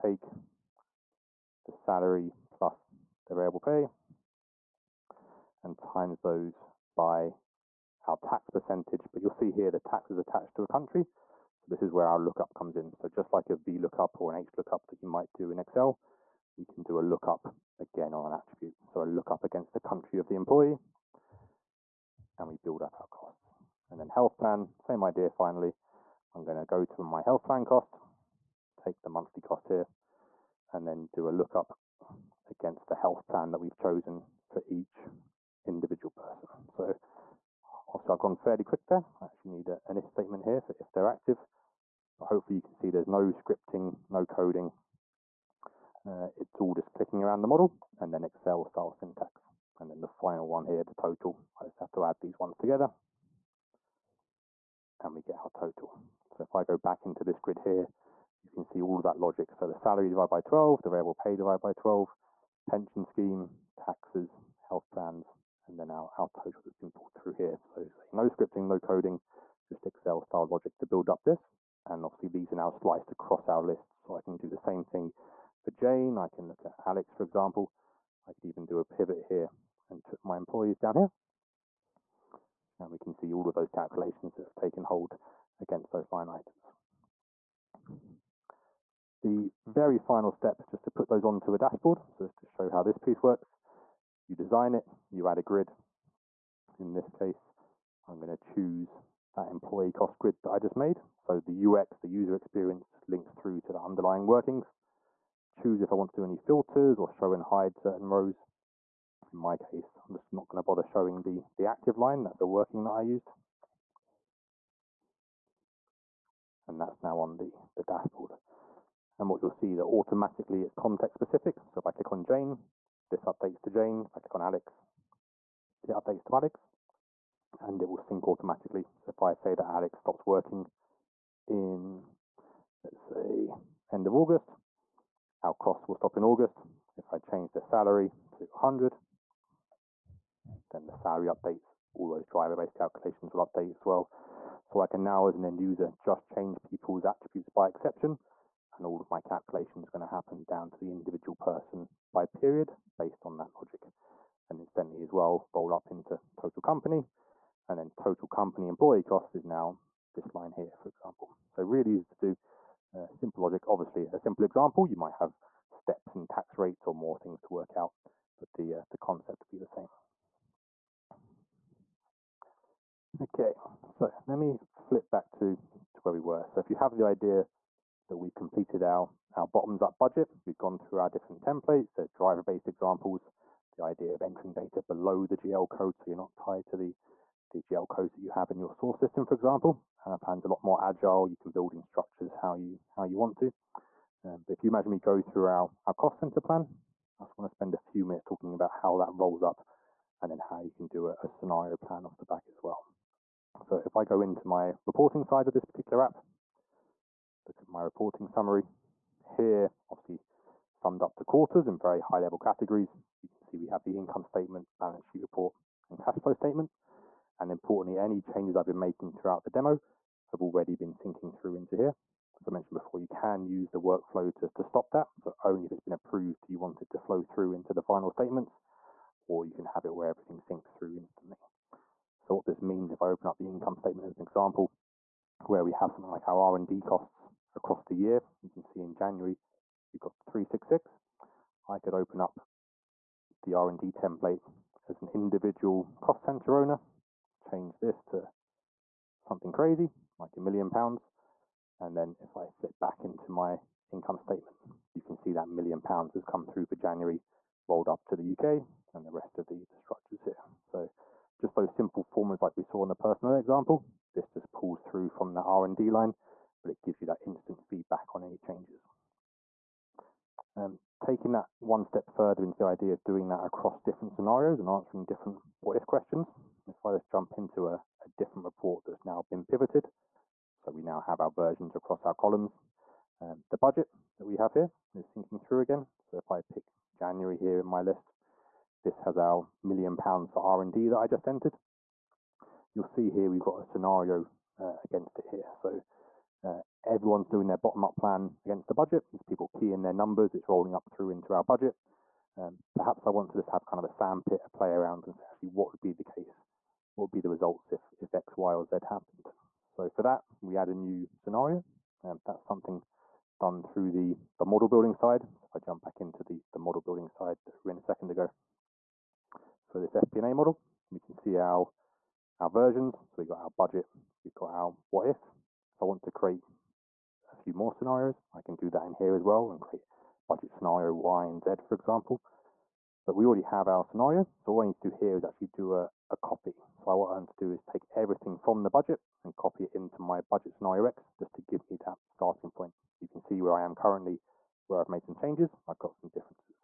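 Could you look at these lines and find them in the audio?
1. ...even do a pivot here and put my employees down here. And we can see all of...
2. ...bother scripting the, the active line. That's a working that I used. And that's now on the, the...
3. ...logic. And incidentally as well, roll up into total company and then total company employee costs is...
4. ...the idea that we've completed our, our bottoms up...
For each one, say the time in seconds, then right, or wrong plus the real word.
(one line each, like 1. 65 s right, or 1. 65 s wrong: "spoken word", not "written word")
1. 78 s right
2. 110 s wrong: "showing", not "scripting"
3. 153 s right
4. 176 s right.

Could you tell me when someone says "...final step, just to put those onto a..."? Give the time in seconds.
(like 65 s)
89 s.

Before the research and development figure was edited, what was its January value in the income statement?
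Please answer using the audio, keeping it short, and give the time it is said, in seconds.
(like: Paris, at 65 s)
366, at 240 s.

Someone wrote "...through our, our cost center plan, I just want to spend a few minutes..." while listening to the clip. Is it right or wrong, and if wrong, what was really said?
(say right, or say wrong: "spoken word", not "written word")
right.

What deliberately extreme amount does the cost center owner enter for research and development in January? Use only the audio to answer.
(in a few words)
a million pounds.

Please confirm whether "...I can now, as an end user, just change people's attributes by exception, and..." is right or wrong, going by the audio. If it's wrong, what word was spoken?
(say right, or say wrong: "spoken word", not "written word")
right.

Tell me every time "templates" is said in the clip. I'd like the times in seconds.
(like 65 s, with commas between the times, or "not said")
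181 s, 243 s.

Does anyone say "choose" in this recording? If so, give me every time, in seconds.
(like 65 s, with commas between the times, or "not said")
98 s, 105 s.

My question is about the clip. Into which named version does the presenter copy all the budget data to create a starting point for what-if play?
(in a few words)
budget scenario X.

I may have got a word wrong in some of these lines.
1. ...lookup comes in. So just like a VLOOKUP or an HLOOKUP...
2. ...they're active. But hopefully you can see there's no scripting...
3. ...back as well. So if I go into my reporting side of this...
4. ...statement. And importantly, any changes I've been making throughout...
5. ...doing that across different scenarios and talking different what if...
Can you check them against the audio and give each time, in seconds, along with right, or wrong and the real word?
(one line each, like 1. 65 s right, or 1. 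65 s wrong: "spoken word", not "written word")
1. 12 s right
2. 40 s right
3. 202 s right
4. 216 s right
5. 273 s wrong: "answering", not "talking".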